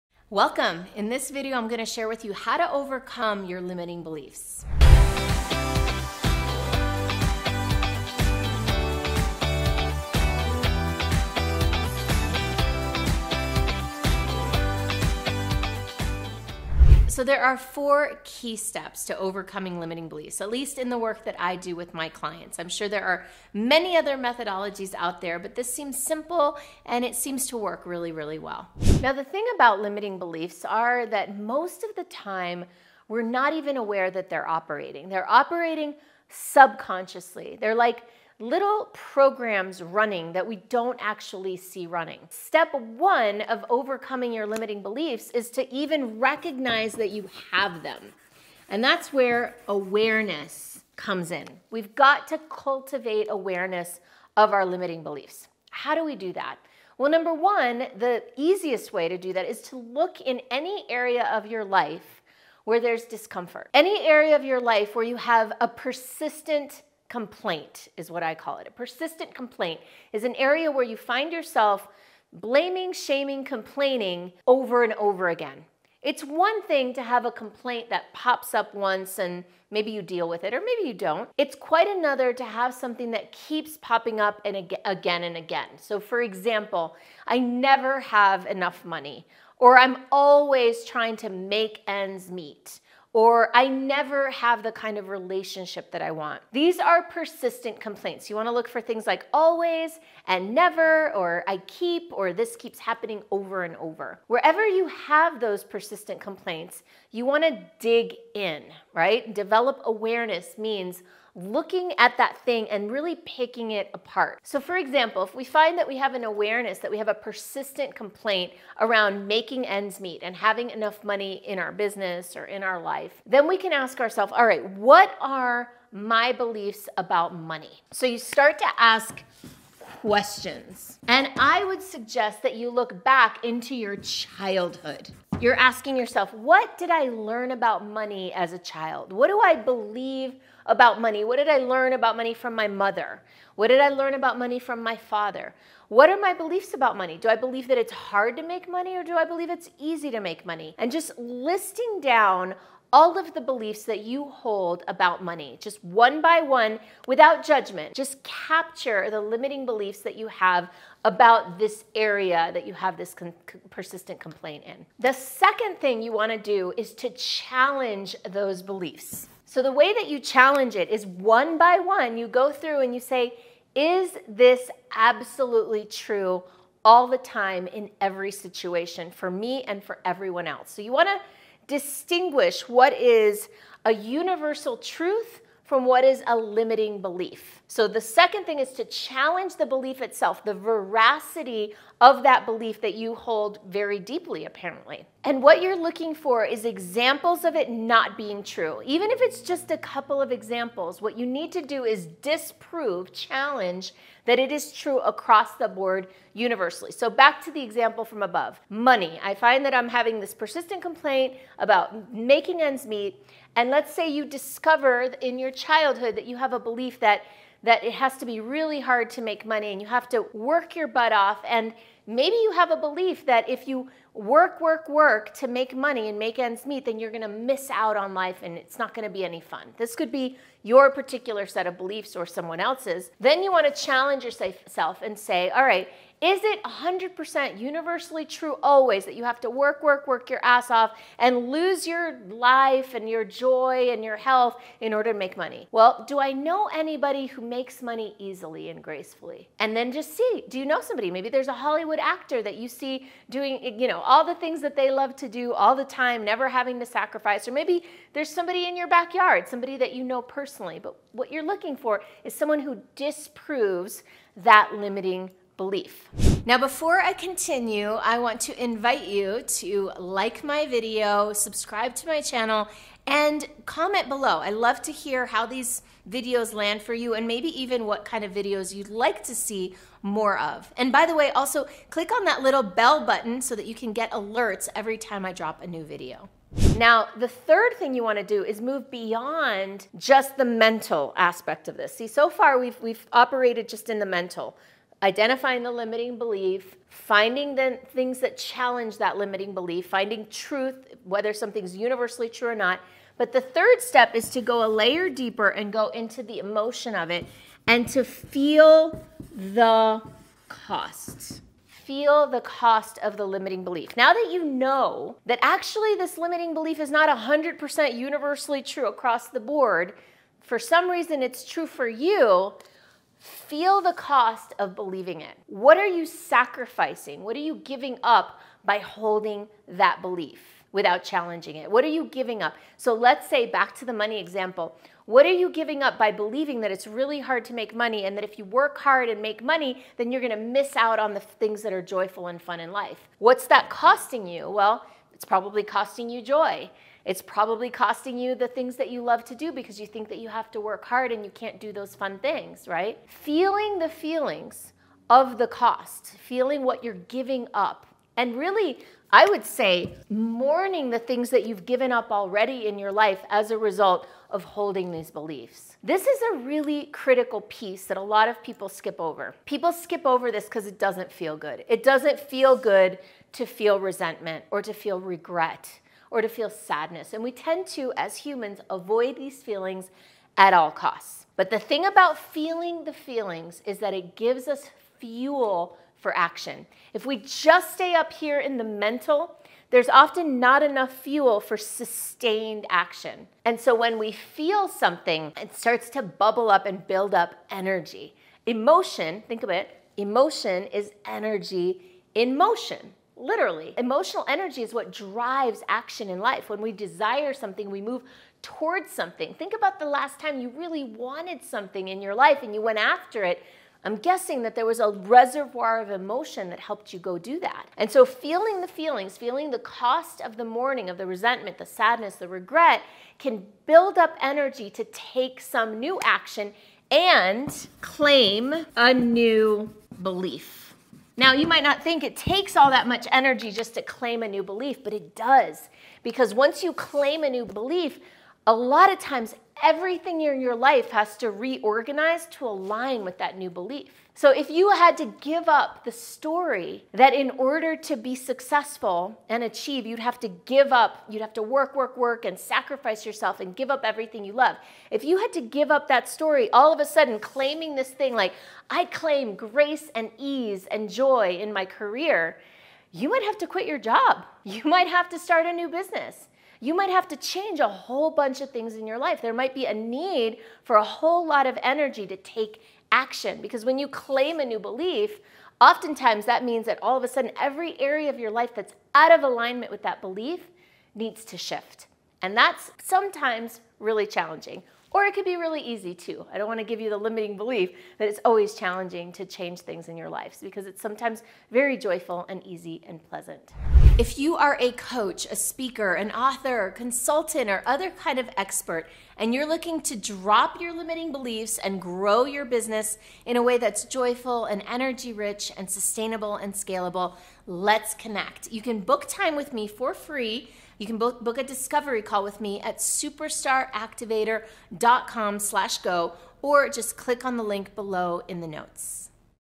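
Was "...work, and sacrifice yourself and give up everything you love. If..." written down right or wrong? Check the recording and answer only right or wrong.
right.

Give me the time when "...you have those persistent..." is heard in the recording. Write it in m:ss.
1:44.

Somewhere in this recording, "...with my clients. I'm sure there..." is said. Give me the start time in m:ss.
0:21.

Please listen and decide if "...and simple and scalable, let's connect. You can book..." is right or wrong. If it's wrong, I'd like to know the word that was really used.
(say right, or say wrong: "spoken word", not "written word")
wrong: "sustainable", not "simple".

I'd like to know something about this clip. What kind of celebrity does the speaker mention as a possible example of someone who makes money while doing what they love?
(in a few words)
Hollywood actor.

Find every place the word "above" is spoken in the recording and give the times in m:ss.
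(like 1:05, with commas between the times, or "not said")
3:28.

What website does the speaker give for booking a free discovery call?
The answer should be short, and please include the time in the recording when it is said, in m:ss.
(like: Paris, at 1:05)
superstaractivator.com, at 8:32.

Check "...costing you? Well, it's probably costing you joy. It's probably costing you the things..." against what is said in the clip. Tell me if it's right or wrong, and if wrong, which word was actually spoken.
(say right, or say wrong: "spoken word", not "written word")
right.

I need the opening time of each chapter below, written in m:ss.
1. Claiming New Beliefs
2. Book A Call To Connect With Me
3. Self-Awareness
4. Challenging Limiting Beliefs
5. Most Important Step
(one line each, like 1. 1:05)
1. 6:58
2. 8:14
3. 0:29
4. 2:45
5. 4:47.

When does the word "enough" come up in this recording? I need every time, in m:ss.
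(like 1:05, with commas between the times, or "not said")
1:28, 2:00, 6:30.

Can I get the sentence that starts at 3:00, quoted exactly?
So you wanna distinguish what is a universal truth from what is a limiting belief.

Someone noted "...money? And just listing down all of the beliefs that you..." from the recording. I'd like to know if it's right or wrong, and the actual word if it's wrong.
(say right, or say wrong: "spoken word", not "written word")
right.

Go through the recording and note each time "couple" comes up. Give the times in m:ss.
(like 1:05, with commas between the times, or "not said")
3:19.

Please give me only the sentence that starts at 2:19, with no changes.
What do I believe about money?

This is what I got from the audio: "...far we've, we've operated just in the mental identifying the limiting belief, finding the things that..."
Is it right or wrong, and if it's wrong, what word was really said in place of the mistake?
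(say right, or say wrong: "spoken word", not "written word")
right.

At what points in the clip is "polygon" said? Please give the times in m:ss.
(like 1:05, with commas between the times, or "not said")
not said.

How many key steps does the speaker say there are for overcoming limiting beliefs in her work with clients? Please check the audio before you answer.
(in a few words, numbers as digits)
4.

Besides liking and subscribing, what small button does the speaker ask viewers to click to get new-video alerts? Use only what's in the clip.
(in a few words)
bell button.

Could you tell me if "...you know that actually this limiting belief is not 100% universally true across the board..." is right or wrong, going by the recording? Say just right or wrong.
right.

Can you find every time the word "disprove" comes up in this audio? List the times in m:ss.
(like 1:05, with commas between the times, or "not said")
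3:22, 4:22.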